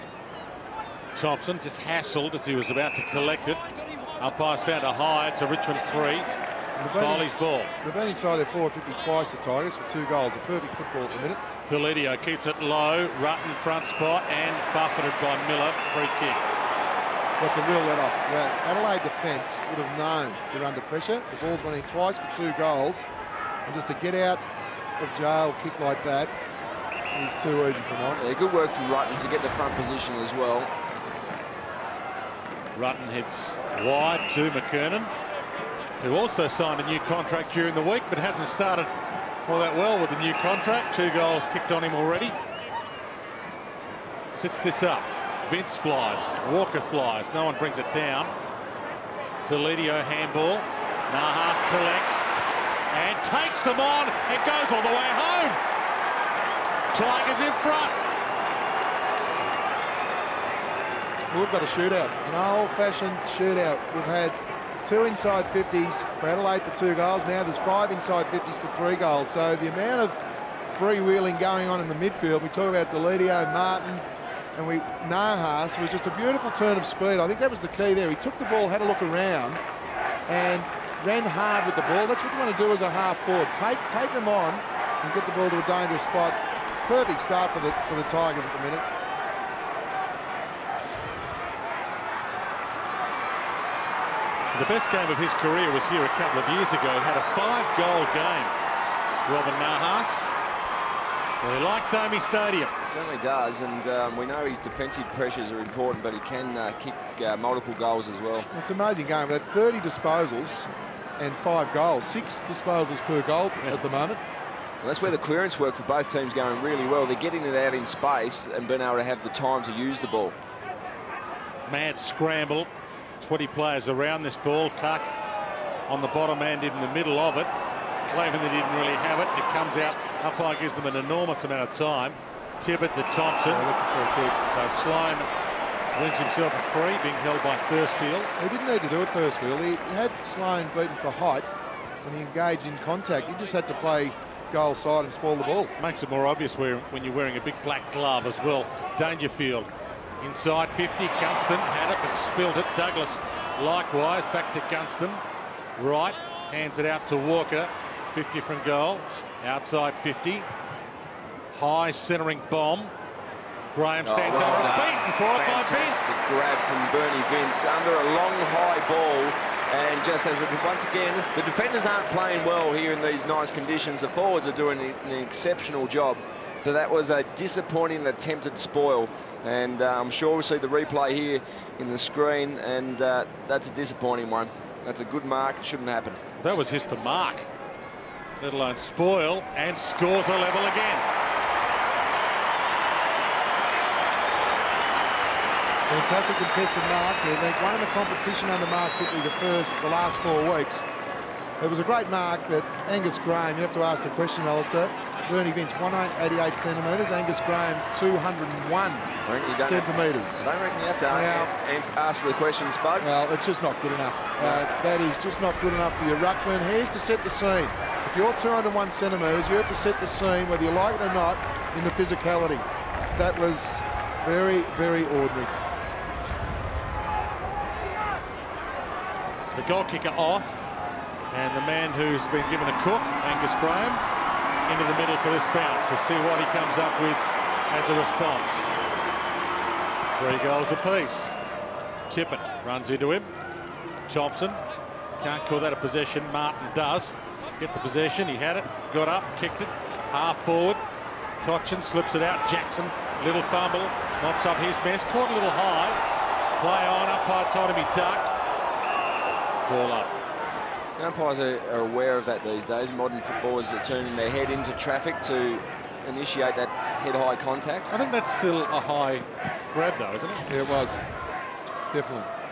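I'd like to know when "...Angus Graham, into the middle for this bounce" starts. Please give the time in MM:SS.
03:53.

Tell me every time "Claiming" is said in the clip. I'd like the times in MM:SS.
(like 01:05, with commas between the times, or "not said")
02:08.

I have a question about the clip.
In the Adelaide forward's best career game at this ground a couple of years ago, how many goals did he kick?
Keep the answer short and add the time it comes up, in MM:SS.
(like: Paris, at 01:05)
5, at 01:37.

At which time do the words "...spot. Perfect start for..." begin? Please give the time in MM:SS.
01:26.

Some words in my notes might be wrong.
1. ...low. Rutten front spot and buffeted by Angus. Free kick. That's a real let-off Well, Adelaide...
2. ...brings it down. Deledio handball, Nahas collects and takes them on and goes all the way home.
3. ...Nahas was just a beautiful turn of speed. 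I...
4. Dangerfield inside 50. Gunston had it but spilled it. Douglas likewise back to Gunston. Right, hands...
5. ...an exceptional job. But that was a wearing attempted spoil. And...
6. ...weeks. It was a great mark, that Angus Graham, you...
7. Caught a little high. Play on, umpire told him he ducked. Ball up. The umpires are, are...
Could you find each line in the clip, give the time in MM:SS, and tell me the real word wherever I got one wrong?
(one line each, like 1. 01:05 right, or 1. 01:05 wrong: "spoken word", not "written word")
1. 00:12 wrong: "Miller", not "Angus"
2. 00:47 right
3. 01:15 right
4. 02:28 right
5. 02:54 wrong: "disappointing", not "wearing"
6. 03:20 right
7. 04:15 right.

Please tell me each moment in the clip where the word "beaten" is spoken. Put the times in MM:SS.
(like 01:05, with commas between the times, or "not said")
02:20, 02:44.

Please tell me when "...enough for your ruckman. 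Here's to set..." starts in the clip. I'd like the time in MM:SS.
03:35.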